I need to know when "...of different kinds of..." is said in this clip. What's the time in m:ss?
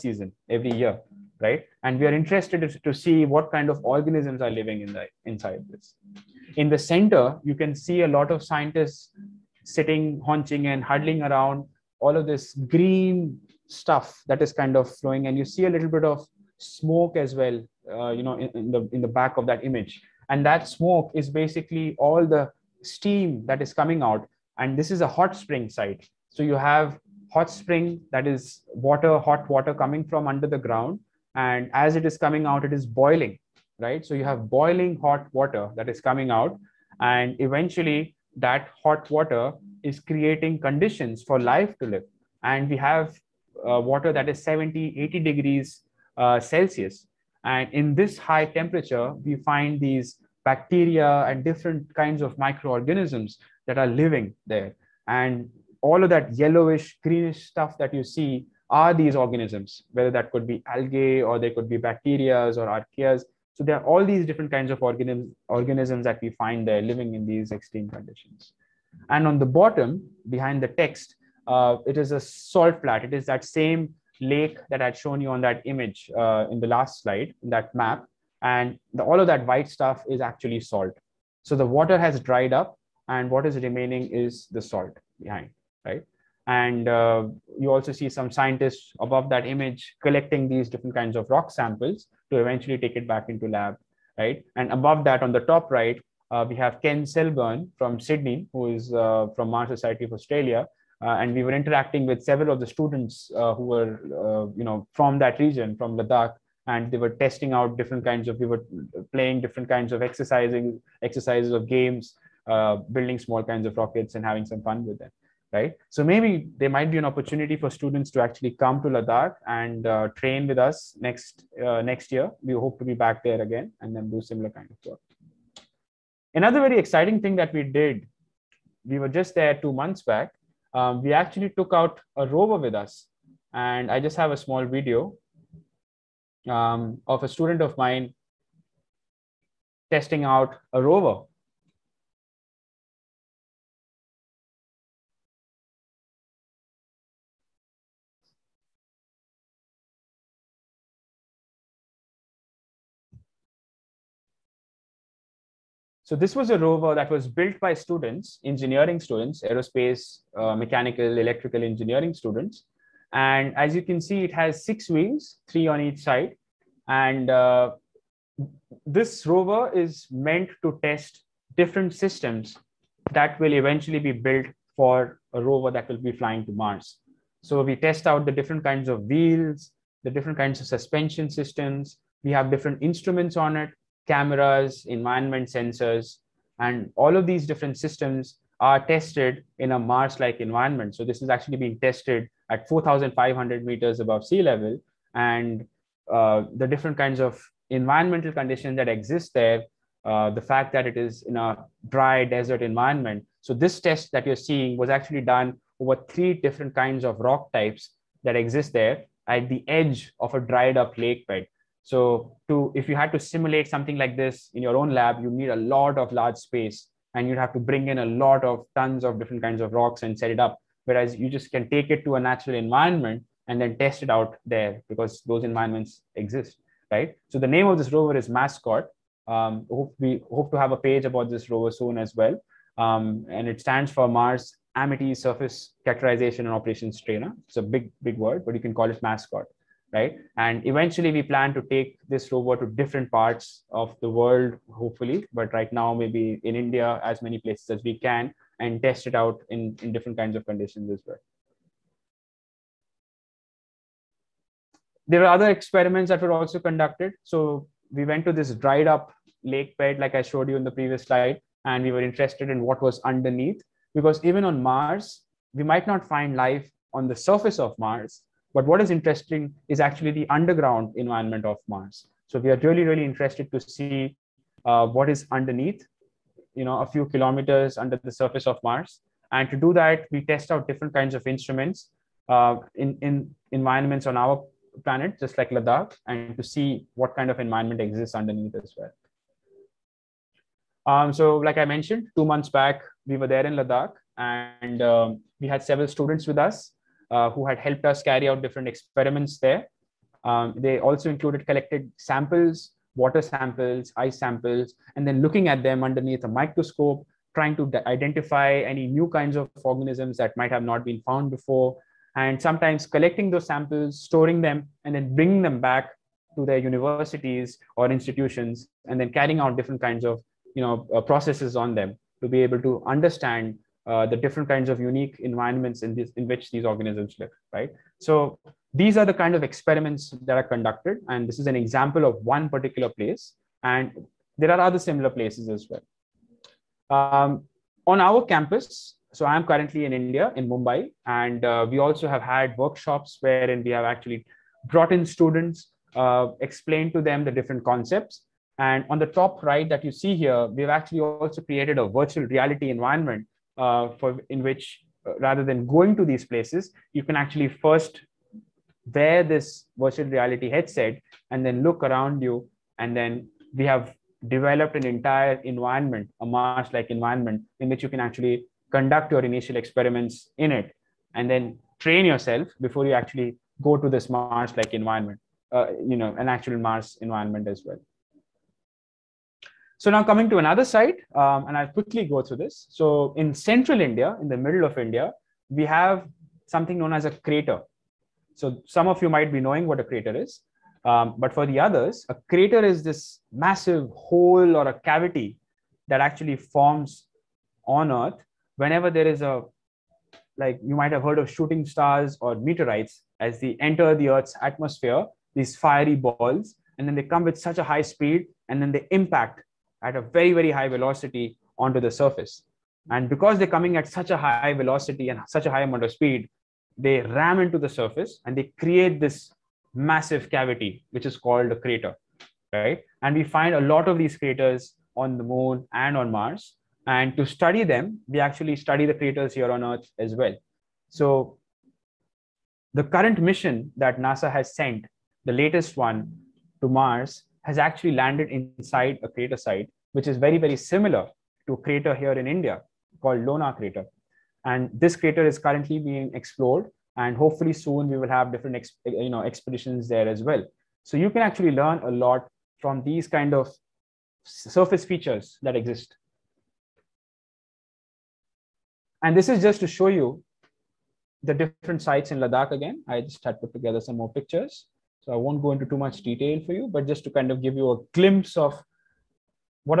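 3:39.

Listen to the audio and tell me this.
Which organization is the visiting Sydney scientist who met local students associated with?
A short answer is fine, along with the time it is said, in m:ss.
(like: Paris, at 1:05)
Mars Society of Australia, at 1:39.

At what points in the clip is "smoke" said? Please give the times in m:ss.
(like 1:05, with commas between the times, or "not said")
0:16, 0:20.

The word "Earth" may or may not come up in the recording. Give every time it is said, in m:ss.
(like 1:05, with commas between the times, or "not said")
6:37, 6:44, 7:09.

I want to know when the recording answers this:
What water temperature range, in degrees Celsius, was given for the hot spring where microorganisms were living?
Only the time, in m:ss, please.
0:44.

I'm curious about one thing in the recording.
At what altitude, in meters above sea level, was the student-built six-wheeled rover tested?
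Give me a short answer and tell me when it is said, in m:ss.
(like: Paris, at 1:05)
4,500, at 3:12.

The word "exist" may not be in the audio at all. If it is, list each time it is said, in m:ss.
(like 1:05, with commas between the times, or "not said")
3:18, 3:28, 3:46, 4:47, 7:35.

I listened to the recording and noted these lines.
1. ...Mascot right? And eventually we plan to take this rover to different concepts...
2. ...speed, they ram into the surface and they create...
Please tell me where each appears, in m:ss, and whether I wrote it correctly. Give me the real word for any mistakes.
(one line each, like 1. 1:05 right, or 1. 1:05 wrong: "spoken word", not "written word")
1. 3:59 wrong: "parts", not "concepts"
2. 6:55 right.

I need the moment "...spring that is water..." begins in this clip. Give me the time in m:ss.
0:27.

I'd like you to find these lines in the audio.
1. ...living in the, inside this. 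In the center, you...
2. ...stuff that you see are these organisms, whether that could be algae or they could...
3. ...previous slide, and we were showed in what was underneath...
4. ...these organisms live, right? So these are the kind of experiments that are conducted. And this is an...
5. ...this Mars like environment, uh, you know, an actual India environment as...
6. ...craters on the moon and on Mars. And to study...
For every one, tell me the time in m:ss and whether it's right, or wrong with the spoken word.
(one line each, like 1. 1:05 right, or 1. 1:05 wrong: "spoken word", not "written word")
1. 0:04 right
2. 0:57 right
3. 4:20 wrong: "interested", not "showed"
4. 5:26 right
5. 6:13 wrong: "Mars", not "India"
6. 7:04 right.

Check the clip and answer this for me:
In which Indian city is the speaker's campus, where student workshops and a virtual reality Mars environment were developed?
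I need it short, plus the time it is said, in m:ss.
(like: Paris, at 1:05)
Mumbai, at 5:40.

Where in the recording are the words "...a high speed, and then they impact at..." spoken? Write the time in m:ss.
6:47.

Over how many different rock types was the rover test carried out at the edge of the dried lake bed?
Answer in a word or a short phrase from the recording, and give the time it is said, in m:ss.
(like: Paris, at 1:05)
3, at 3:26.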